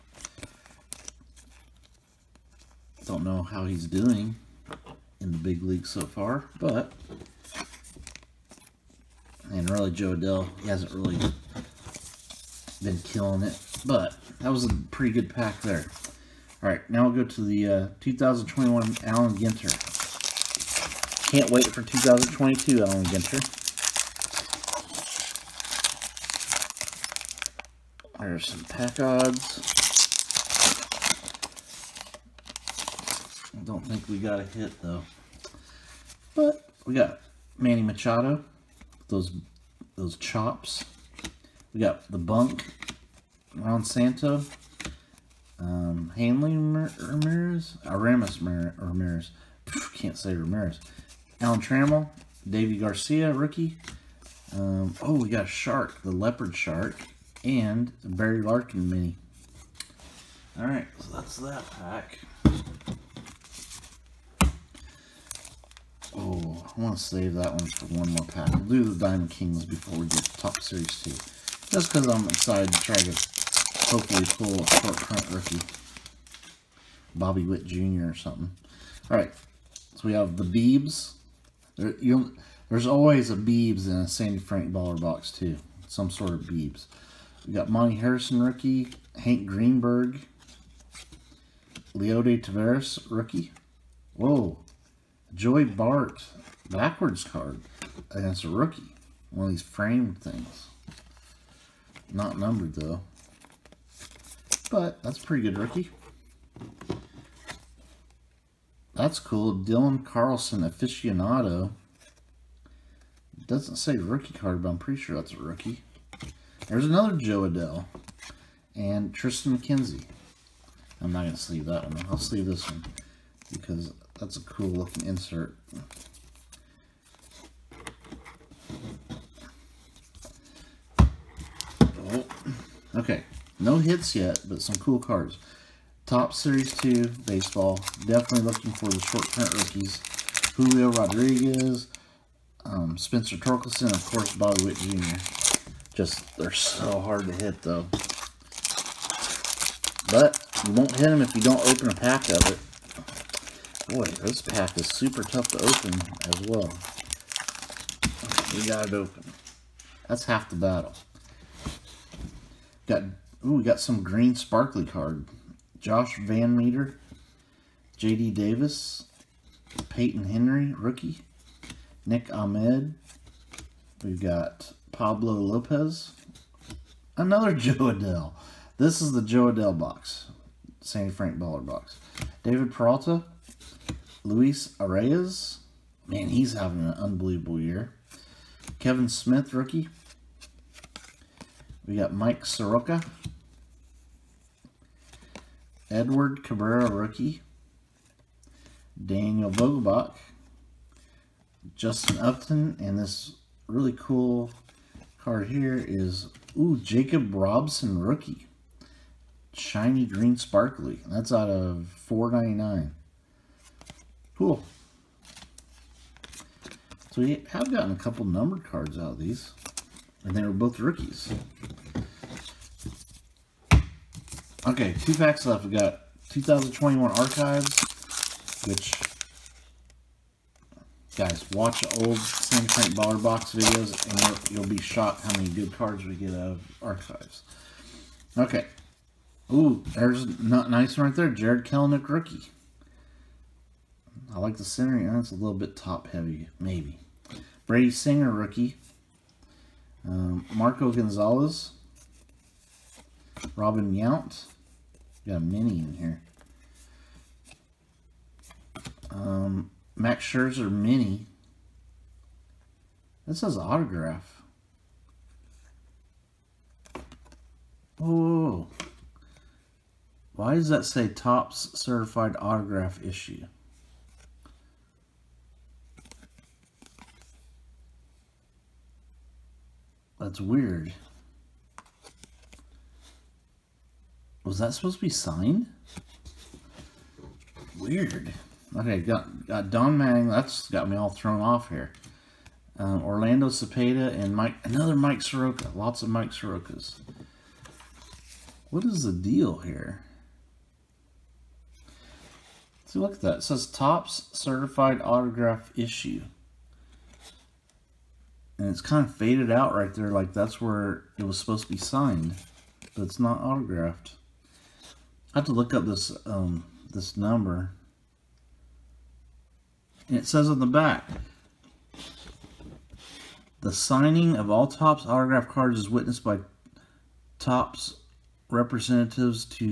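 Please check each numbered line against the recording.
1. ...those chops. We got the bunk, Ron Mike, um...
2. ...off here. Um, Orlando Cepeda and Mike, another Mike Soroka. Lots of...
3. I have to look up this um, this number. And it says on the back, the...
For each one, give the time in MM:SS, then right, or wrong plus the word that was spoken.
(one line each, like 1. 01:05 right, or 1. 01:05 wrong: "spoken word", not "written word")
1. 00:39 wrong: "Santo", not "Mike"
2. 04:51 right
3. 05:15 right.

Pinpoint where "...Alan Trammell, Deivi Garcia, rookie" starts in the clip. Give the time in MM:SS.
00:51.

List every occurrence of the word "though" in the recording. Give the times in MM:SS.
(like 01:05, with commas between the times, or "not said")
00:34, 01:42, 02:27.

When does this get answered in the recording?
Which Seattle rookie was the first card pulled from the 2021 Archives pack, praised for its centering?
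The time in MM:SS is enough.
04:01.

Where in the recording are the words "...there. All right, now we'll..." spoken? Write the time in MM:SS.
00:15.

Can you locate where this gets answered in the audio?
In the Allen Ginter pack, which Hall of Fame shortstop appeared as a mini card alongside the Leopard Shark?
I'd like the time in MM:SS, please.
00:58.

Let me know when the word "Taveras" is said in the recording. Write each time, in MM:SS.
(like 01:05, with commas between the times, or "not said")
01:32.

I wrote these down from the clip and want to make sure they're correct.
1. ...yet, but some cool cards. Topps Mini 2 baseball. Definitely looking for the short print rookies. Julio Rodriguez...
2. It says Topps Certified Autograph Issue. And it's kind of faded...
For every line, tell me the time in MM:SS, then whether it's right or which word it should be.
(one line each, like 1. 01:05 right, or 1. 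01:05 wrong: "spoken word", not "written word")
1. 02:14 wrong: "Series", not "Mini"
2. 05:03 right.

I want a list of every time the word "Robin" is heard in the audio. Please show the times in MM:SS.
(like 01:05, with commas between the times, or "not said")
04:13.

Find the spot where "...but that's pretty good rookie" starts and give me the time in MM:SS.
01:44.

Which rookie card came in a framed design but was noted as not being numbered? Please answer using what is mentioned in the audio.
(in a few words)
Joey Bart.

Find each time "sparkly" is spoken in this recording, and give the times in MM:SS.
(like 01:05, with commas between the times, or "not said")
02:44, 03:30.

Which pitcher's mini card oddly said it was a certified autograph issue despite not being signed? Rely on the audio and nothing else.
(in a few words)
Max Scherzer.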